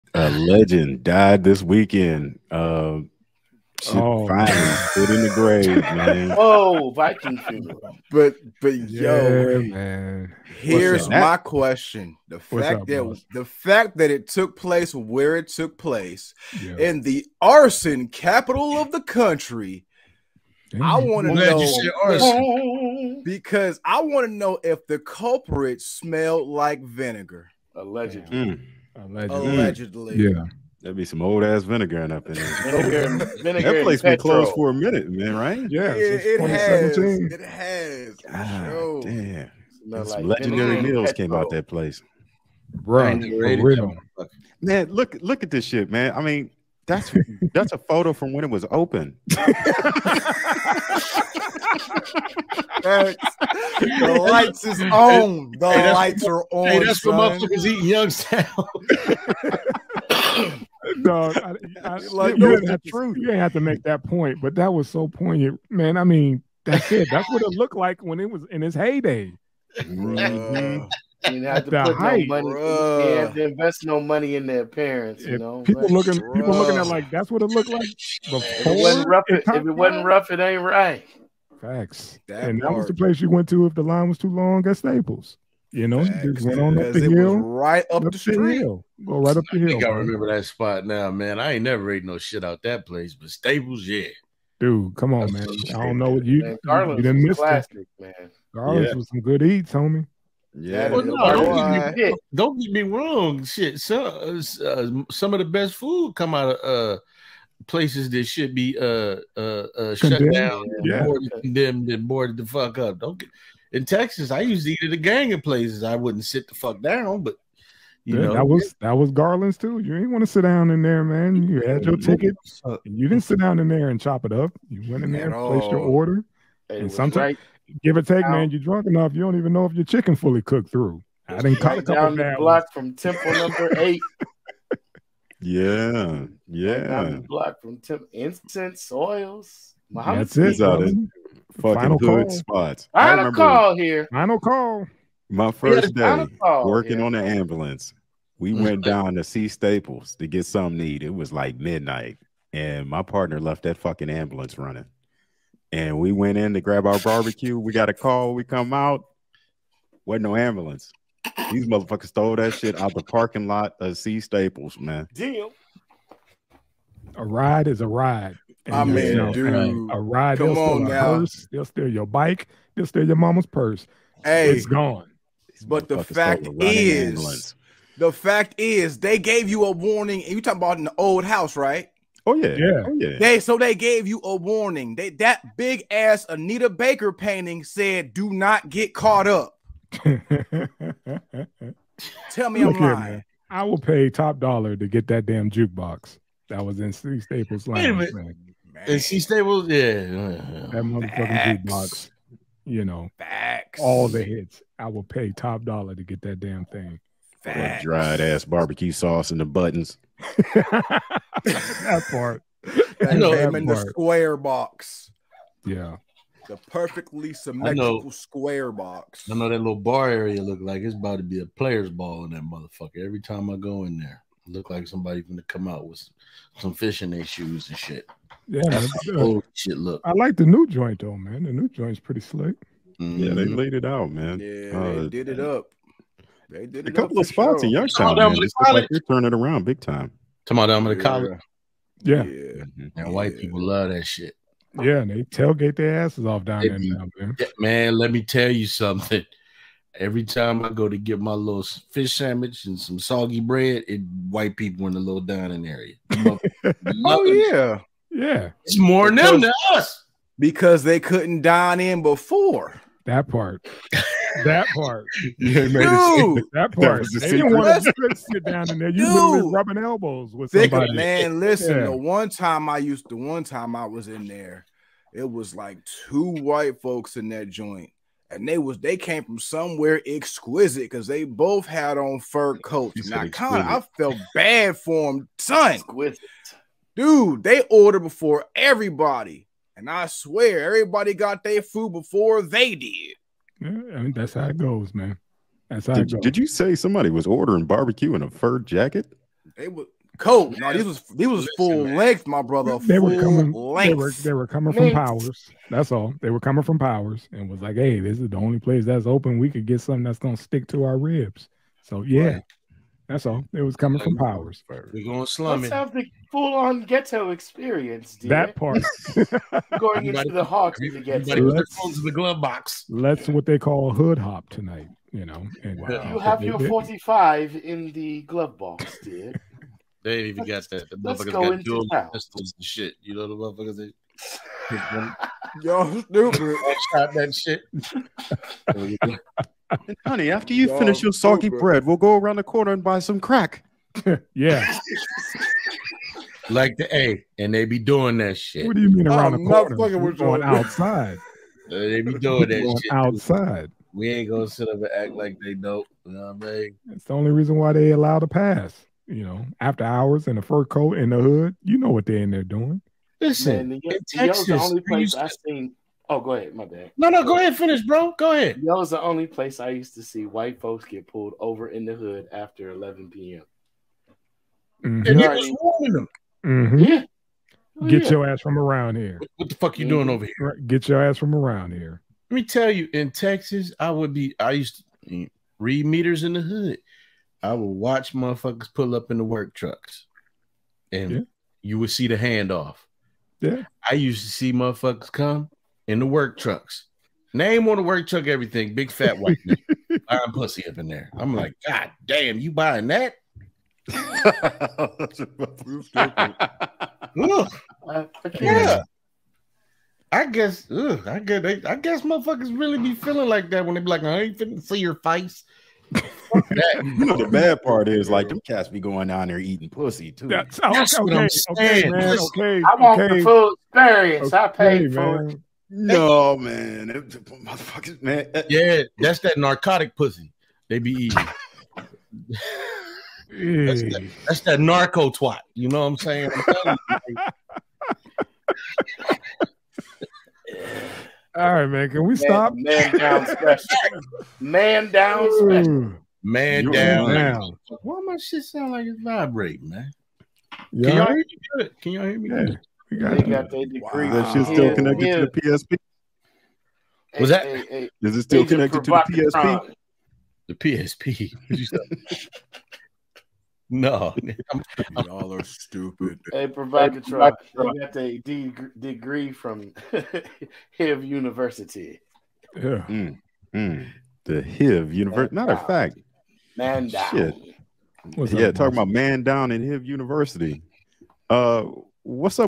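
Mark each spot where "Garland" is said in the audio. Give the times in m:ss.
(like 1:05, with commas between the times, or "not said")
1:38, 1:59.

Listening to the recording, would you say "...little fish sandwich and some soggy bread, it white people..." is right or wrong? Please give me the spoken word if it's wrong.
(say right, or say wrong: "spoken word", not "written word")
right.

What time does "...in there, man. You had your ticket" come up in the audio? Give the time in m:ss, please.
2:00.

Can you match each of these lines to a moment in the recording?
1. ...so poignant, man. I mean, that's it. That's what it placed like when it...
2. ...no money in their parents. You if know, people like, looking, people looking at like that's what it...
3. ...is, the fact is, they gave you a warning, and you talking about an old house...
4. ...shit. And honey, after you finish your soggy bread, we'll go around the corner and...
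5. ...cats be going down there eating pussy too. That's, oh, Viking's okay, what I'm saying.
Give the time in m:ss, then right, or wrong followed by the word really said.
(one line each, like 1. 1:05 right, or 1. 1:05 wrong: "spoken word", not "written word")
1. 1:04 wrong: "looked", not "placed"
2. 1:13 right
3. 2:56 right
4. 5:37 right
5. 6:58 wrong: "That", not "Viking".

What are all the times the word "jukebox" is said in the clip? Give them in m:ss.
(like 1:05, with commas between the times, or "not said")
3:15, 3:21.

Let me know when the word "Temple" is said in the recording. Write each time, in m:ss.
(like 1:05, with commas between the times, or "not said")
2:12, 2:17.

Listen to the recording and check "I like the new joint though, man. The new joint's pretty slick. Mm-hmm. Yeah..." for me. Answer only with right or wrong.
right.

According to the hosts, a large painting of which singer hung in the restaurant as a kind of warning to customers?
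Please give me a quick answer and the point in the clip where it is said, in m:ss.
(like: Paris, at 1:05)
Anita Baker, at 3:06.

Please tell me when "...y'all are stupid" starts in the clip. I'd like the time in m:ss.
7:45.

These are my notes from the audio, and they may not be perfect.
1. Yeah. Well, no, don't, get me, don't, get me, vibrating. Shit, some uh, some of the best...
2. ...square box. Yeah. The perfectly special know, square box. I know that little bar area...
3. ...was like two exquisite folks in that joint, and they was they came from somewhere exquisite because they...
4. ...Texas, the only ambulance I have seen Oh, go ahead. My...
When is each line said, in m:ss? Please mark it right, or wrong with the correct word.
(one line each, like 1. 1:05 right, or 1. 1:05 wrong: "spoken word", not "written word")
1. 1:40 wrong: "wrong", not "vibrating"
2. 3:33 wrong: "symmetrical", not "special"
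3. 4:35 wrong: "white", not "exquisite"
4. 6:04 wrong: "place", not "ambulance".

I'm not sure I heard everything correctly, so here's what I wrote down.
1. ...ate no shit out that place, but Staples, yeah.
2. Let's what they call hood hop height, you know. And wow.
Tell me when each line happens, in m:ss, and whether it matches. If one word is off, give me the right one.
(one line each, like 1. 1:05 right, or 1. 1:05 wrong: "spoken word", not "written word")
1. 1:31 right
2. 5:22 wrong: "tonight", not "height".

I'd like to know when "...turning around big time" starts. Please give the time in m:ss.
3:58.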